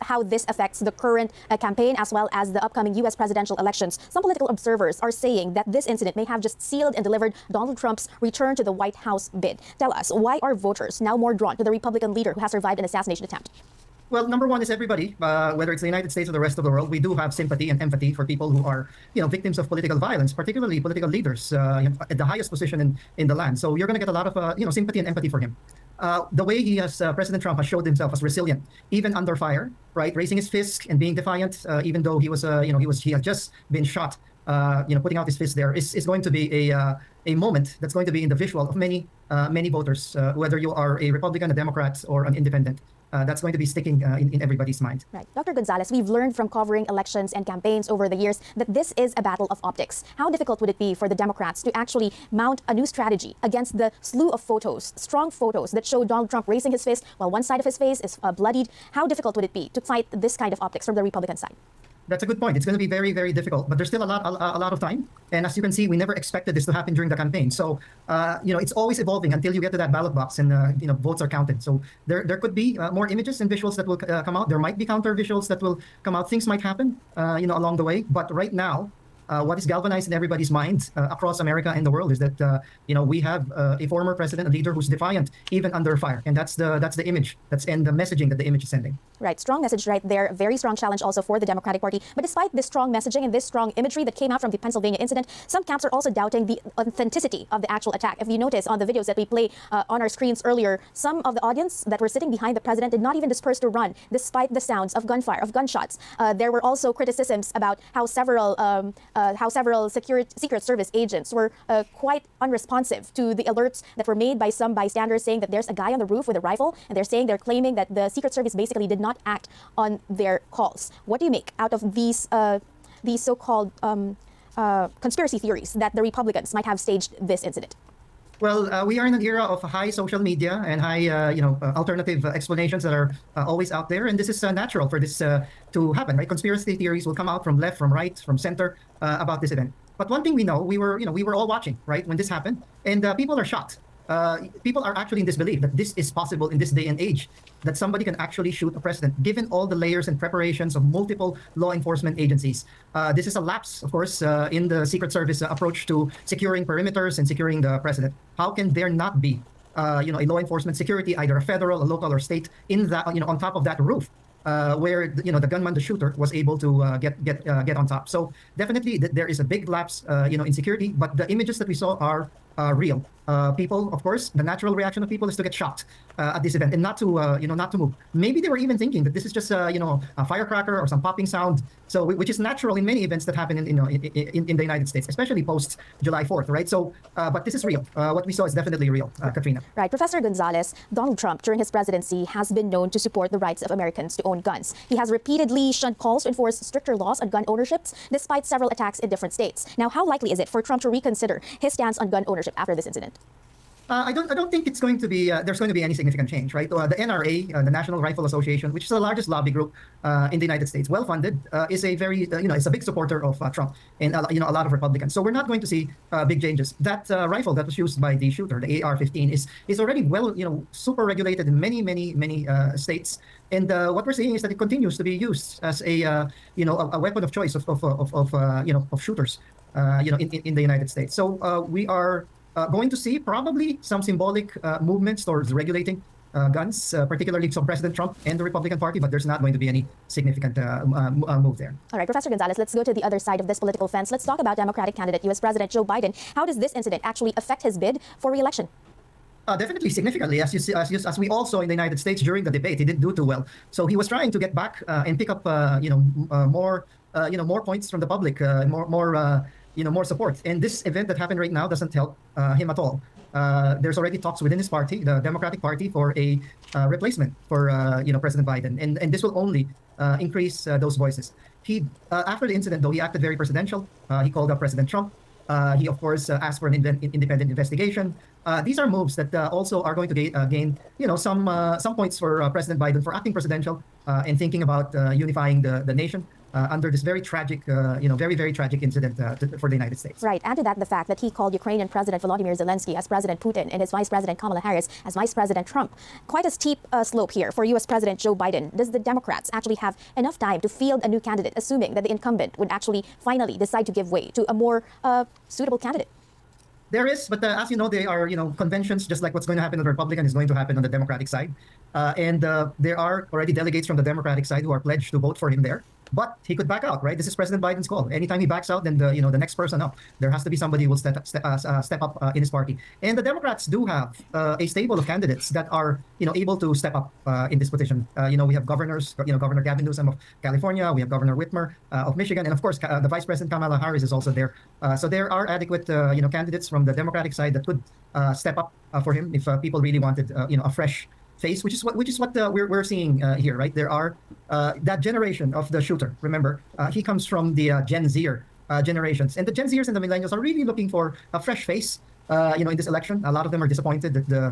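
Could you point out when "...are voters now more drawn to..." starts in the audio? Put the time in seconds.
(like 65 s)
10 s.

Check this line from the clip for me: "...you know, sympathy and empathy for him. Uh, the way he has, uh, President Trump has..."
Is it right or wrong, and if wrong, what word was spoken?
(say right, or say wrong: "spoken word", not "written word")
right.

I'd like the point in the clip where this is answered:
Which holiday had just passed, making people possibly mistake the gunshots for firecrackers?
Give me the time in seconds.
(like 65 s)
186 s.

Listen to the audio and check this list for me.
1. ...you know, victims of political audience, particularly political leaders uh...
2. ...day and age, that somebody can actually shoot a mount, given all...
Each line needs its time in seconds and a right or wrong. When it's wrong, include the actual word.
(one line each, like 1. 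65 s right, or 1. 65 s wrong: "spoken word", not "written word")
1. 19 s wrong: "violence", not "audience"
2. 146 s wrong: "president", not "mount".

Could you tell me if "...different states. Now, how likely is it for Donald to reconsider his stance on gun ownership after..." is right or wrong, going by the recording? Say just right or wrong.
wrong.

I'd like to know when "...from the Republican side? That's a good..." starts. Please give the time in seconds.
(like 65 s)
60 s.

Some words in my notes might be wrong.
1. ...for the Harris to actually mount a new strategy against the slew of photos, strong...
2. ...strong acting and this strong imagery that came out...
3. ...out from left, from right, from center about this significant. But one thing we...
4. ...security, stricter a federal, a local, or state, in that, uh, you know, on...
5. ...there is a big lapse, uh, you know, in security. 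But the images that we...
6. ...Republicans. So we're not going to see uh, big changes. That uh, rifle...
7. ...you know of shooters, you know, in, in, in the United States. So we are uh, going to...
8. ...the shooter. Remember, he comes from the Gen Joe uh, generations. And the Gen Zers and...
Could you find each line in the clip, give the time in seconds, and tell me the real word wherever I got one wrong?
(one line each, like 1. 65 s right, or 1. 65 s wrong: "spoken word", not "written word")
1. 50 s wrong: "Democrats", not "Harris"
2. 92 s wrong: "messaging", not "acting"
3. 137 s wrong: "event", not "significant"
4. 160 s wrong: "either", not "stricter"
5. 169 s right
6. 214 s right
7. 228 s right
8. 345 s wrong: "Zer", not "Joe".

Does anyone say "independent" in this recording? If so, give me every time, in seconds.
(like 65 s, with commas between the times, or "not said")
42 s, 276 s.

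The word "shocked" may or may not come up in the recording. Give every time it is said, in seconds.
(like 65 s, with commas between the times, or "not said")
143 s, 175 s.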